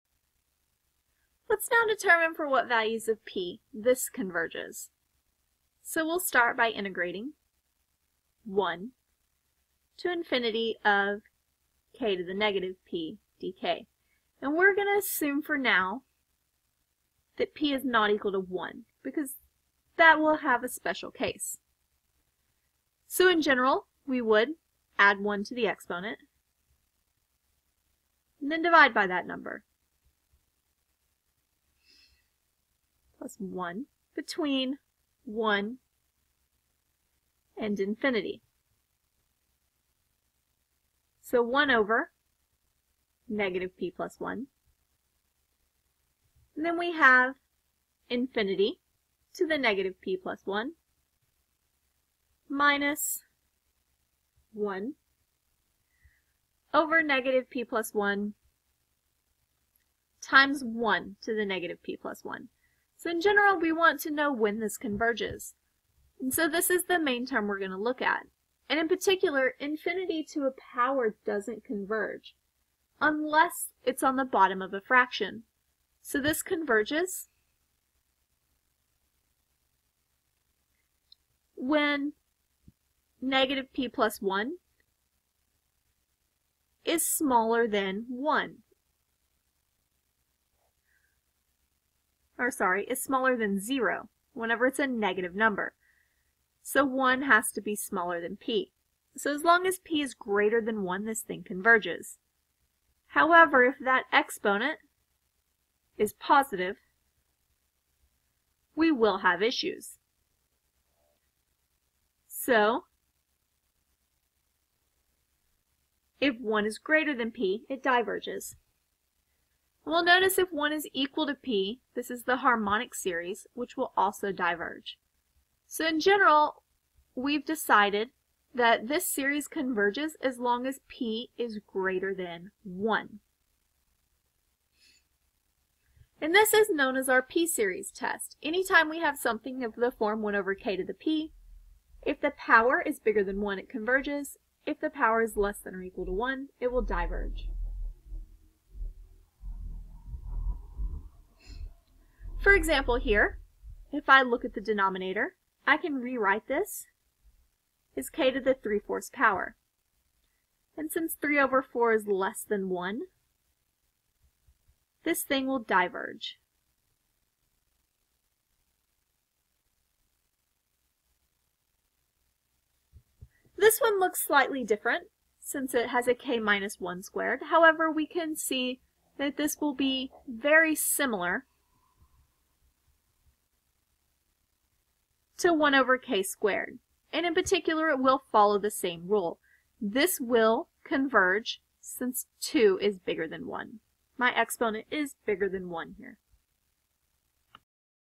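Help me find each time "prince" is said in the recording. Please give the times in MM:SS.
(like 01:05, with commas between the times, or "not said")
not said.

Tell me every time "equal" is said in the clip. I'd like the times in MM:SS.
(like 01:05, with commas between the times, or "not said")
00:18, 02:00, 02:25.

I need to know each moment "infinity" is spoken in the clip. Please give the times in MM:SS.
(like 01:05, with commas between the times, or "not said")
00:10, 00:37, 00:48, 01:09.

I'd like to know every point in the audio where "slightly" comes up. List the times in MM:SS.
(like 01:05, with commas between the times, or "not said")
02:54.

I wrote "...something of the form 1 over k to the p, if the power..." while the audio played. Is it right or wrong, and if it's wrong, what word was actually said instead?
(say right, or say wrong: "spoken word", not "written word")
right.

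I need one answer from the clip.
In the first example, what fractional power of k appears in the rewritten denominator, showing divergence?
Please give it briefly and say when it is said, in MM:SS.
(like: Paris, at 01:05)
3/4, at 02:38.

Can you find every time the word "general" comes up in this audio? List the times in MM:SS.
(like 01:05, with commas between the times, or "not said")
00:23, 01:03, 02:05.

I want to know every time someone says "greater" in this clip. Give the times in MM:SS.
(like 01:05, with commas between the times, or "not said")
01:40, 01:56, 02:11.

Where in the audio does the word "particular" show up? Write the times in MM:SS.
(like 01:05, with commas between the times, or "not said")
01:08, 03:07.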